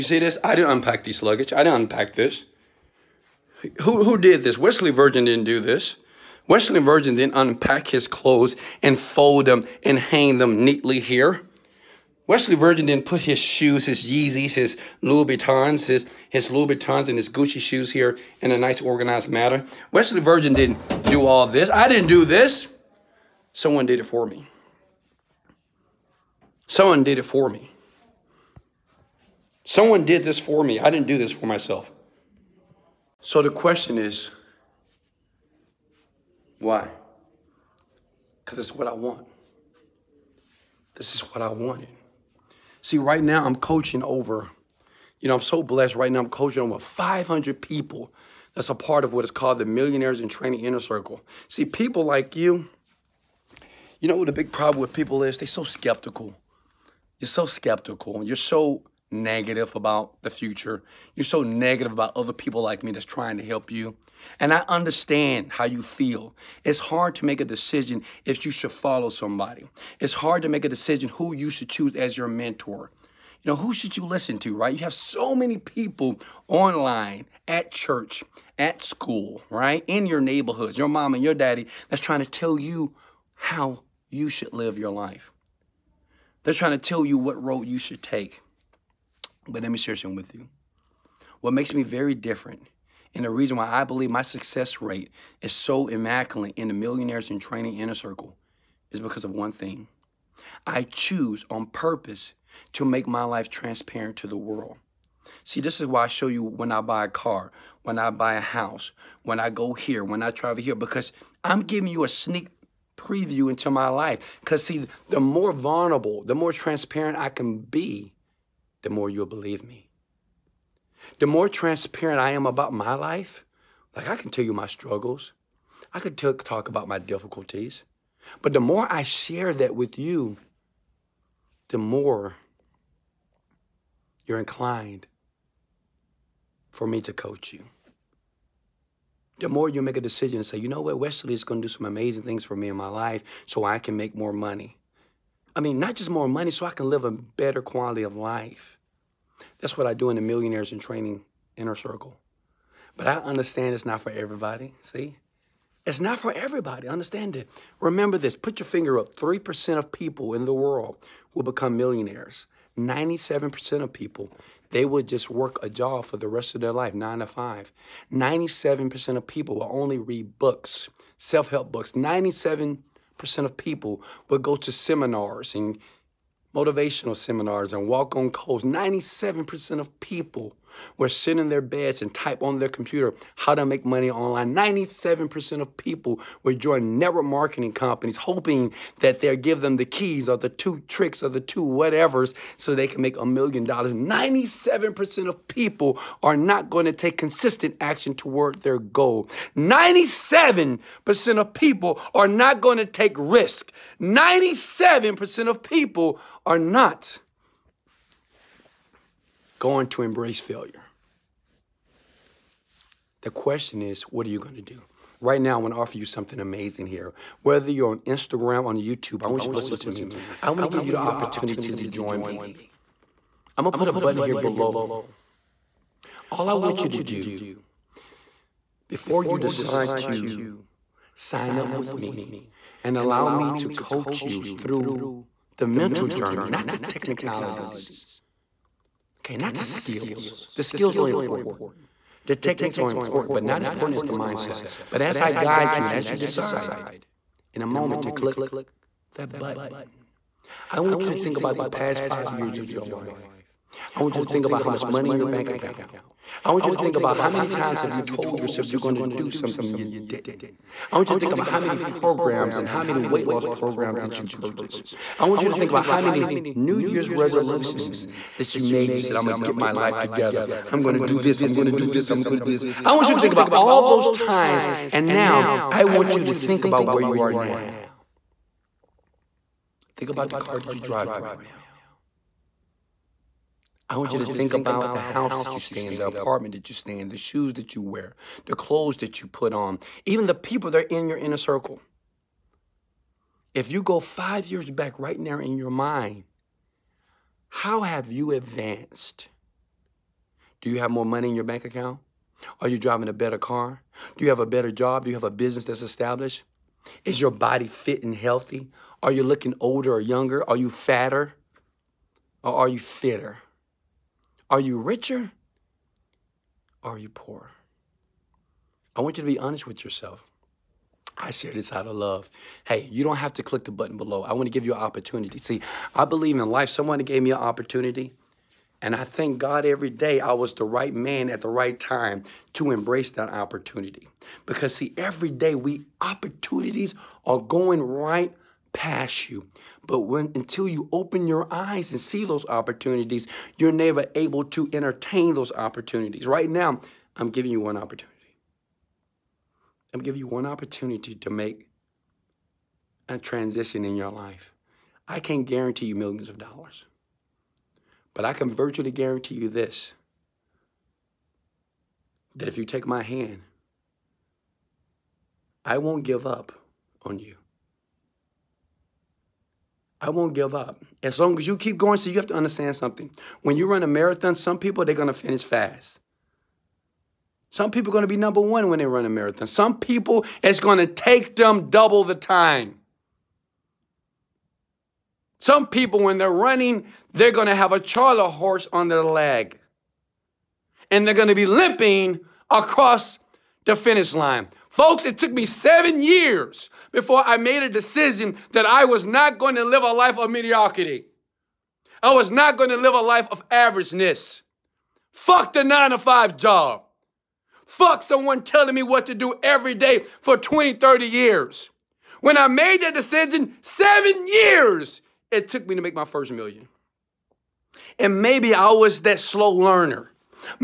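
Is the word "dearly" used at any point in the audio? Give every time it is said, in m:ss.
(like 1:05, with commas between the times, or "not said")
not said.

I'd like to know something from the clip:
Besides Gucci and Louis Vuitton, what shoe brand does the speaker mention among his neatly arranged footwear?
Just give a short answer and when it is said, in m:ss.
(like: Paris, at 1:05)
Yeezys, at 0:14.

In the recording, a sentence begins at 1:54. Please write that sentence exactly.
Because, see, the more vulnerable, the more transparent I can be, the more you'll believe me.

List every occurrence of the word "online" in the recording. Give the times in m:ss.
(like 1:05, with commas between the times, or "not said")
1:16, 3:04.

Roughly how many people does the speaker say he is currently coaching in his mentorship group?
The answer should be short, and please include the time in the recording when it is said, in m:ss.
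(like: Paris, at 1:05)
500, at 0:46.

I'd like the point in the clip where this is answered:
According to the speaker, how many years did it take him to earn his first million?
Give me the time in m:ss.
6:53.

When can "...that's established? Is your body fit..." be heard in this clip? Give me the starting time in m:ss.
5:05.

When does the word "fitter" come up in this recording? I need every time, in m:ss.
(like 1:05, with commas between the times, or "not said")
5:12.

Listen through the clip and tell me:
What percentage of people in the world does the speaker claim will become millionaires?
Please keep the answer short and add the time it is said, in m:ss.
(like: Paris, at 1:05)
3%, at 2:39.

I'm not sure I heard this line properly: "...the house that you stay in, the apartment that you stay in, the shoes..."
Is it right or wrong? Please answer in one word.
right.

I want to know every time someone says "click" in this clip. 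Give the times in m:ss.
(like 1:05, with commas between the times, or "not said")
4:08, 5:23.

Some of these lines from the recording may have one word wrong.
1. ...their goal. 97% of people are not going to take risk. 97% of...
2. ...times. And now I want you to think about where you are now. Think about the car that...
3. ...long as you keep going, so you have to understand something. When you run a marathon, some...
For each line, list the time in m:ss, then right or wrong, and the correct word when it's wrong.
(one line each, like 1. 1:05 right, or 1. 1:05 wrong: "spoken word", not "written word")
1. 3:18 right
2. 4:34 right
3. 6:11 right.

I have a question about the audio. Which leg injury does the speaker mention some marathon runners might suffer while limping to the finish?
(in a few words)
charley horse.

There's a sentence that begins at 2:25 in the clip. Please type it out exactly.
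I mean, not just more money, so I can live a better quality of life.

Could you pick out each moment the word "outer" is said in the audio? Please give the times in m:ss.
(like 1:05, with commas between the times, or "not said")
not said.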